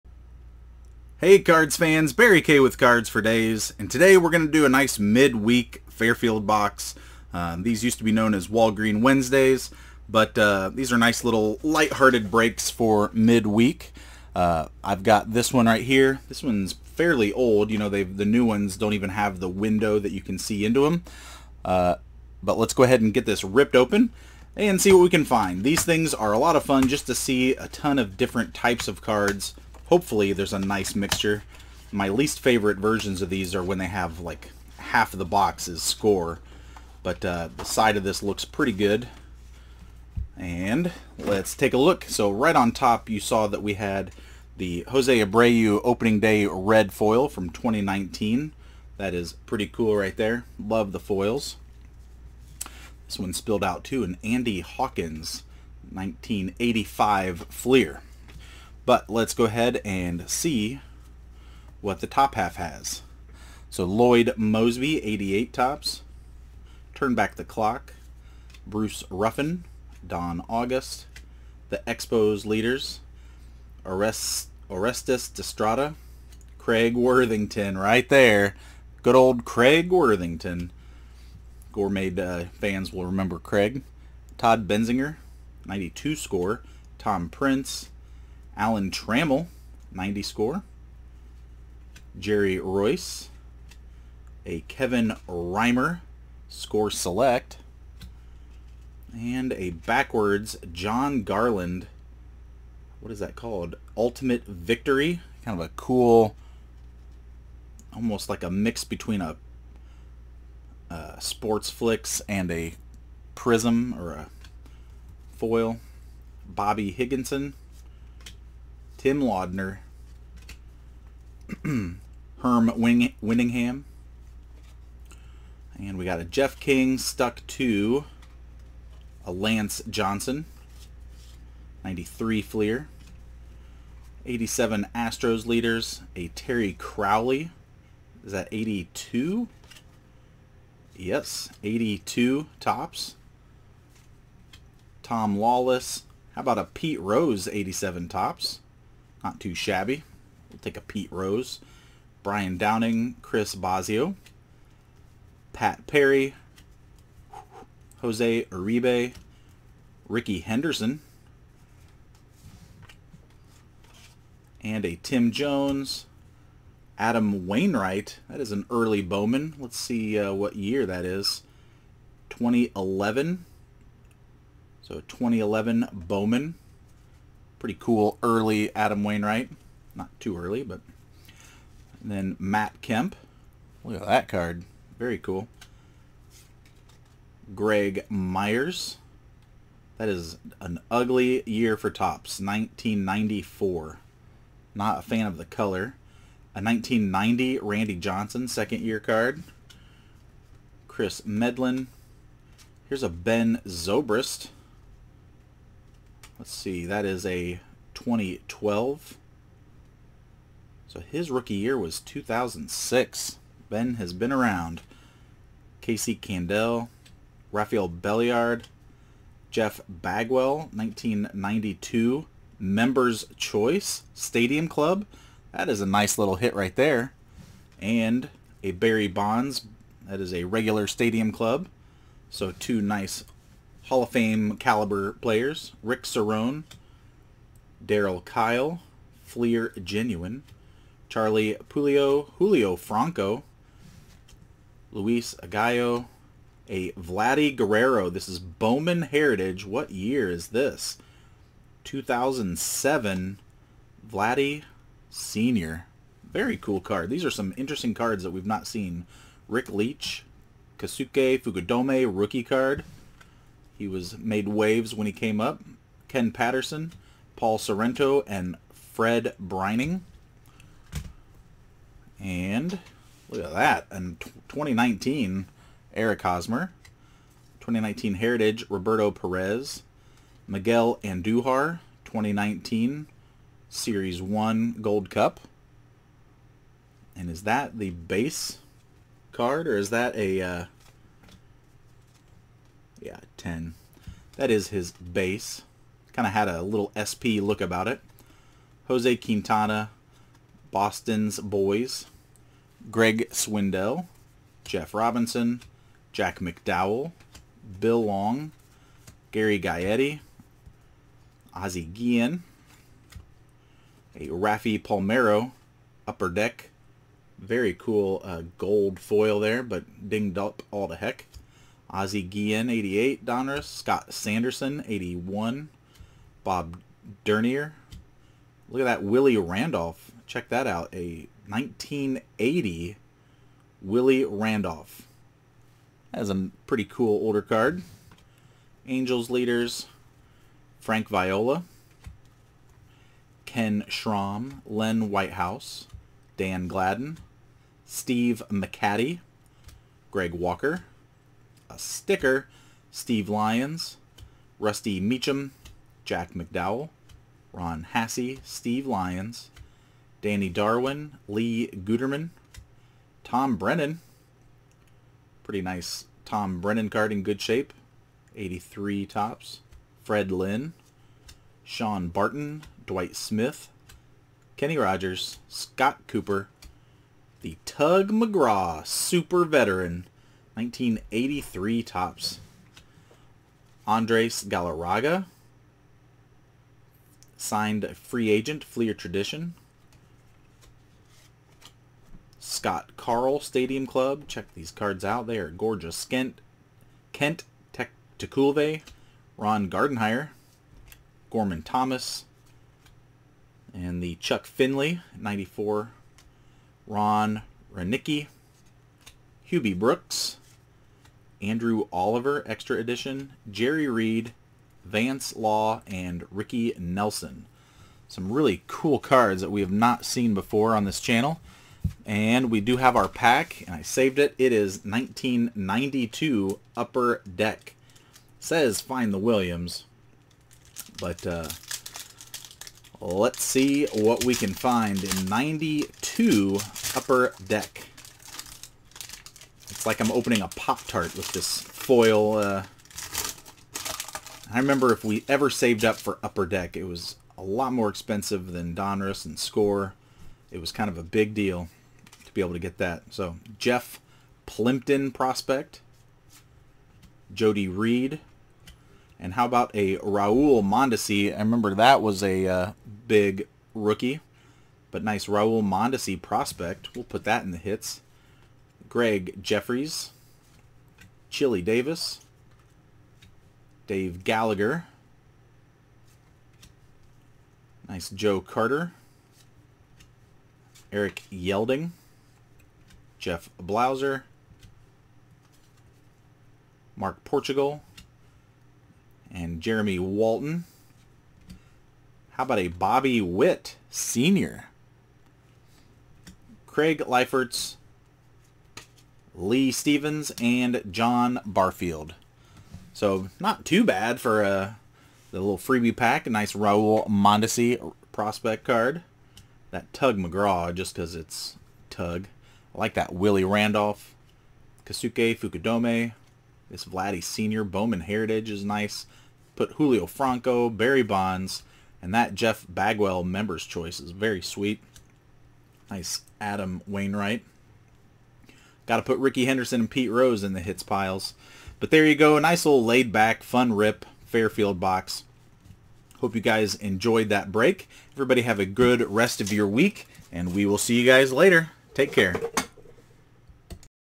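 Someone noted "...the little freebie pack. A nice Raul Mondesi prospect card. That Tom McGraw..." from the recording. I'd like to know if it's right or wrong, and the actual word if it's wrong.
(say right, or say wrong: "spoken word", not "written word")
wrong: "Tug", not "Tom".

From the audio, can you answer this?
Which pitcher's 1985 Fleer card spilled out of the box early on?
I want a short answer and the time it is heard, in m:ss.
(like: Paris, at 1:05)
Andy Hawkins, at 0:54.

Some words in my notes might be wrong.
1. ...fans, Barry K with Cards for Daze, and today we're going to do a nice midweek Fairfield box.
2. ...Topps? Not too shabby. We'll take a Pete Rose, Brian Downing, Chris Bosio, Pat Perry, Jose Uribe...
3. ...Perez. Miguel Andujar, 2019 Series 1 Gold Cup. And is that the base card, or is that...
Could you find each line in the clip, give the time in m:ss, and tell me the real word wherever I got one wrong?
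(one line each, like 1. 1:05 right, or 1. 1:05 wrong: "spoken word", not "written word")
1. 0:01 right
2. 2:28 right
3. 4:39 right.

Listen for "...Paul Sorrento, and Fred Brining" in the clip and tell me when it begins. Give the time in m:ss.
4:27.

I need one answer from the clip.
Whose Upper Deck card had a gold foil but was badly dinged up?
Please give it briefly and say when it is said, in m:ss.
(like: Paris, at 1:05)
Raffy Palmeiro, at 5:14.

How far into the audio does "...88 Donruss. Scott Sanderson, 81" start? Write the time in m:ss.
5:22.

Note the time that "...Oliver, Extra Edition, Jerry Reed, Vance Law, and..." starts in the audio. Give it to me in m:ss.
6:51.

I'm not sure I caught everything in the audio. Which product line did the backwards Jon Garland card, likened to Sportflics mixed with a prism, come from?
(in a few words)
Ultimate Victory.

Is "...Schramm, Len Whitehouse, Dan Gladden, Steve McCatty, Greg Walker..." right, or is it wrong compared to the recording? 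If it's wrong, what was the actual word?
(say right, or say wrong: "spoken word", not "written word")
right.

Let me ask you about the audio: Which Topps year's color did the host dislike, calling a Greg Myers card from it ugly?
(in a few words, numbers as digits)
1994.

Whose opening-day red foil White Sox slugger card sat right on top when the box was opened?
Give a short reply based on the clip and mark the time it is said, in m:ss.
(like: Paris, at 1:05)
Jose Abreu, at 0:44.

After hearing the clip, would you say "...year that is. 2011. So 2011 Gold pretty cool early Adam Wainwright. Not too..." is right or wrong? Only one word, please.
wrong.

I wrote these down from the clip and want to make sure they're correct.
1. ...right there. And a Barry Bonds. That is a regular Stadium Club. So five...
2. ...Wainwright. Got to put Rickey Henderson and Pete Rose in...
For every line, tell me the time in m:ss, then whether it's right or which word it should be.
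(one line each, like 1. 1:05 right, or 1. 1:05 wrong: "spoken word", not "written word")
1. 3:46 wrong: "two", not "five"
2. 8:46 right.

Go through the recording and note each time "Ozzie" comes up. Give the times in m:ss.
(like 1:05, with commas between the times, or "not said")
5:11, 5:21.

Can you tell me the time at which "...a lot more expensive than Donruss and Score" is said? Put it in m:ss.
7:27.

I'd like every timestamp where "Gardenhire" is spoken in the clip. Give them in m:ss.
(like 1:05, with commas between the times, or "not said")
6:39.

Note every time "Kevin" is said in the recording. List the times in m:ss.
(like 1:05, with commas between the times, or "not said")
1:34.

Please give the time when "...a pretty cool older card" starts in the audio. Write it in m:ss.
5:36.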